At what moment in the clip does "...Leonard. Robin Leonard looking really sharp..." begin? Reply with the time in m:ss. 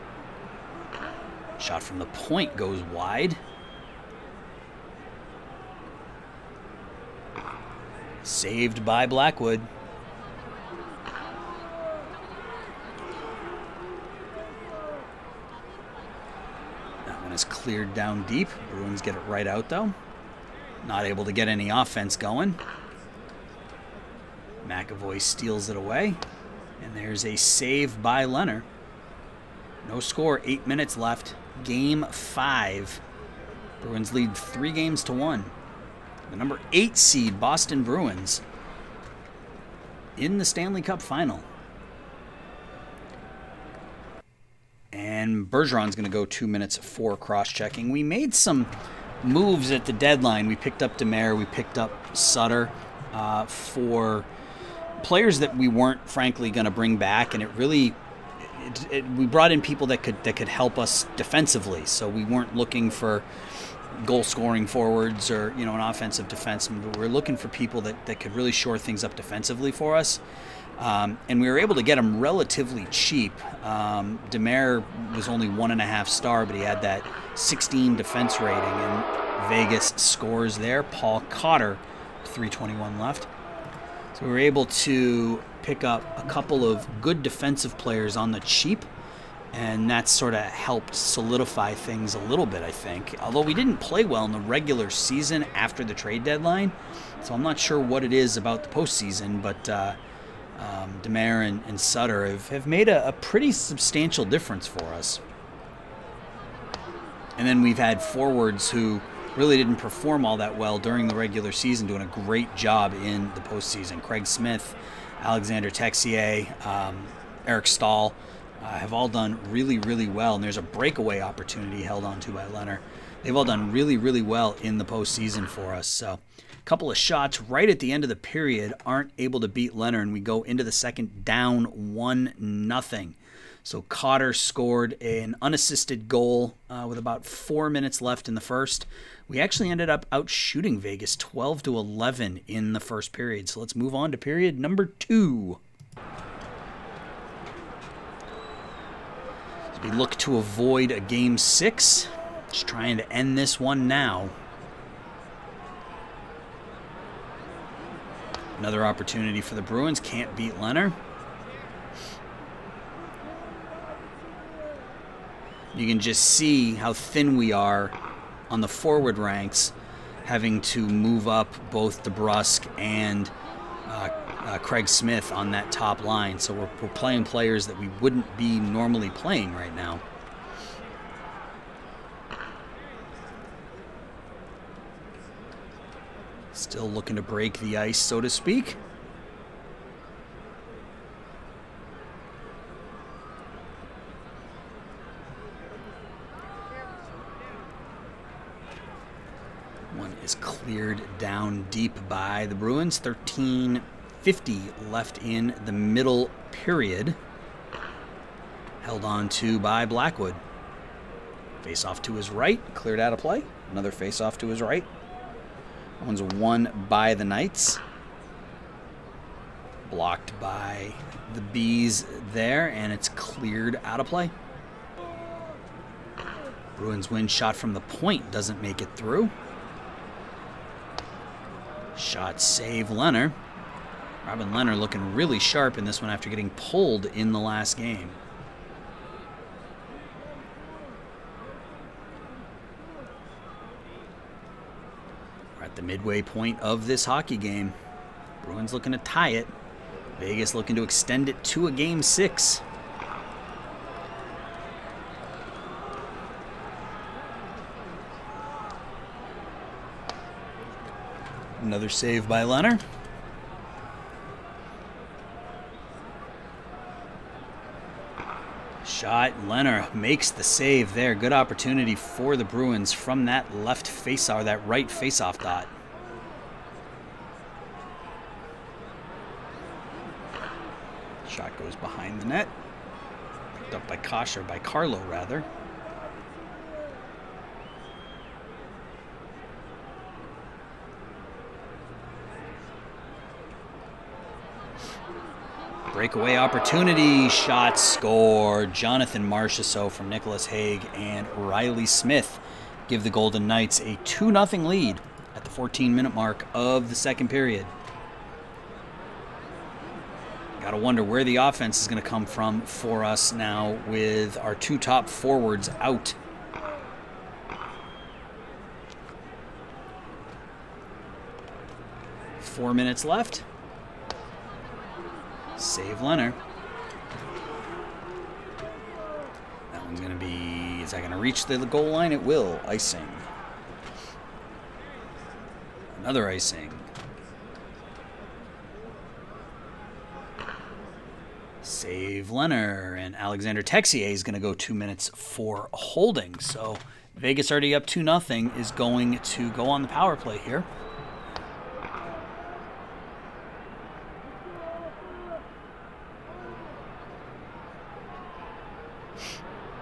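3:52.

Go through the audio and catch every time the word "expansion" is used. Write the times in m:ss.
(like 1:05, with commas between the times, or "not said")
not said.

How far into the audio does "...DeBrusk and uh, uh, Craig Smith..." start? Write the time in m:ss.
2:52.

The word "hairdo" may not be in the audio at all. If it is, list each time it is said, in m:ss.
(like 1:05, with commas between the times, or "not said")
not said.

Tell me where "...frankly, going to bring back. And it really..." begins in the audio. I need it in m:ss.
0:56.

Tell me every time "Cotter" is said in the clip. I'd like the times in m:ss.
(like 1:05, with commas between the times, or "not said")
1:21, 2:13.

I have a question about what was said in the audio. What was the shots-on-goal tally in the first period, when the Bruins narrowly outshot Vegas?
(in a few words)
12 to 11.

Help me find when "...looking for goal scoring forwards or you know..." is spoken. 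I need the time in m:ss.
1:02.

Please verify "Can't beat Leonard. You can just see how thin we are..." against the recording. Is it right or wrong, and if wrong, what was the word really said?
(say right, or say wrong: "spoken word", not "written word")
right.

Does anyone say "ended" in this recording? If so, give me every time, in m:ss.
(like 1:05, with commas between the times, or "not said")
2:19.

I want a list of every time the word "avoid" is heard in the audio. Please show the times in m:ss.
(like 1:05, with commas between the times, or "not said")
2:30.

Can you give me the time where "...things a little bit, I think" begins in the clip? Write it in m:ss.
1:31.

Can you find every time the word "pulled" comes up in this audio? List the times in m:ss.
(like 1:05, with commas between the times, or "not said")
3:56.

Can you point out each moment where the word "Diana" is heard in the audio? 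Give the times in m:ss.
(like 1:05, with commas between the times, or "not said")
not said.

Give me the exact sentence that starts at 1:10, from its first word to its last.
Um, and we were able to get them relatively cheap.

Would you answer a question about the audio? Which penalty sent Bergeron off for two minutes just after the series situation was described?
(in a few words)
cross checking.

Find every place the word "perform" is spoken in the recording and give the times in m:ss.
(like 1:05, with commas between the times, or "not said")
1:49.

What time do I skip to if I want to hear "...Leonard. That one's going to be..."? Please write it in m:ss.
5:26.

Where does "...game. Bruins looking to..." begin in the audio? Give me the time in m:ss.
4:07.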